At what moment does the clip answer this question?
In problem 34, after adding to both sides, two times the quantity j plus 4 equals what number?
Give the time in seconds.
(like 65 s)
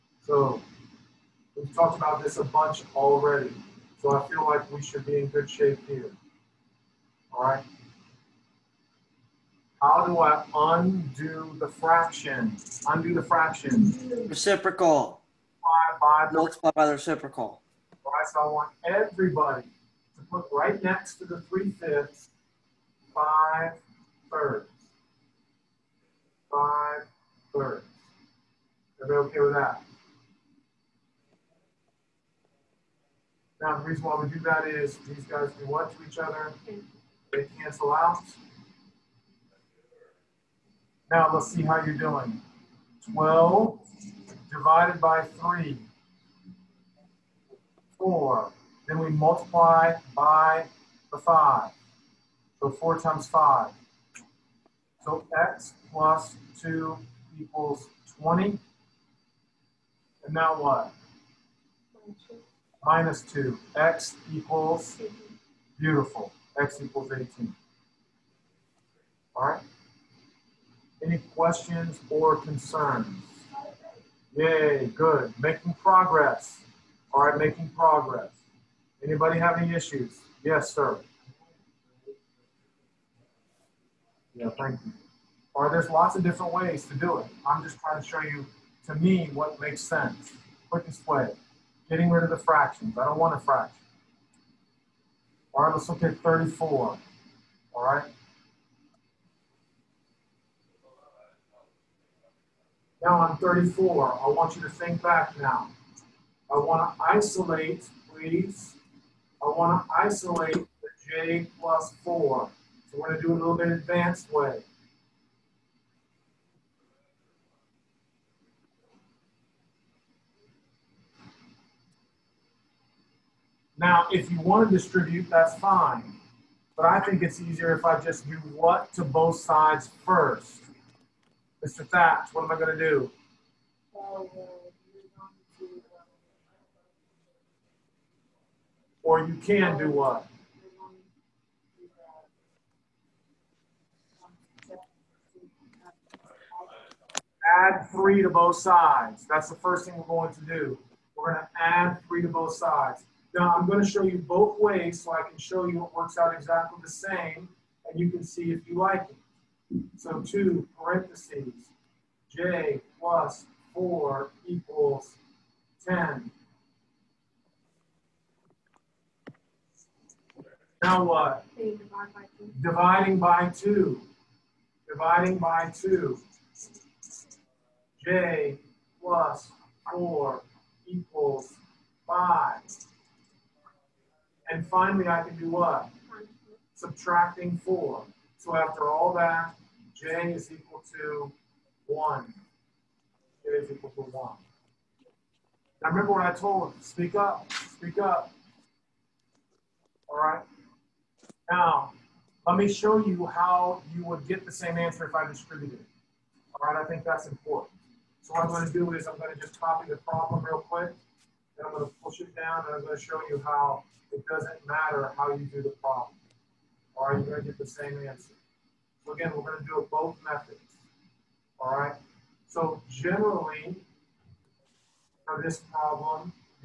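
165 s.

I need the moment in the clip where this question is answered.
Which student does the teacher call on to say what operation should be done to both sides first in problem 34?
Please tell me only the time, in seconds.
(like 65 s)
131 s.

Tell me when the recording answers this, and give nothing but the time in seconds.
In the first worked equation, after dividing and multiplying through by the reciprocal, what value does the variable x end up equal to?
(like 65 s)
66 s.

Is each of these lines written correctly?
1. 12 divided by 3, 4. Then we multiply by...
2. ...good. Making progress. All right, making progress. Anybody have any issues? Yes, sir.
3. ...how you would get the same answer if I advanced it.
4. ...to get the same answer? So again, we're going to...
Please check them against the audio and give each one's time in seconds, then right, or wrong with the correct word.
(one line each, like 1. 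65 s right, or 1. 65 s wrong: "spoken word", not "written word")
1. 43 s right
2. 74 s right
3. 203 s wrong: "distributed", not "advanced"
4. 217 s right.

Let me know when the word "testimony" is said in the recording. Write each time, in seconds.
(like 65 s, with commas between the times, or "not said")
not said.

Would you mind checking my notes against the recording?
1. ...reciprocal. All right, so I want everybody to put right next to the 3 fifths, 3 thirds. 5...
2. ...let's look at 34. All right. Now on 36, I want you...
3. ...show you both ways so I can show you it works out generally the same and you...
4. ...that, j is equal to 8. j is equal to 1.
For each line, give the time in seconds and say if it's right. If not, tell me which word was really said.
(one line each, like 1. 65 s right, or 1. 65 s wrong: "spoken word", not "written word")
1. 16 s wrong: "5", not "3"
2. 95 s wrong: "34", not "36"
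3. 153 s wrong: "exactly", not "generally"
4. 189 s wrong: "1", not "8".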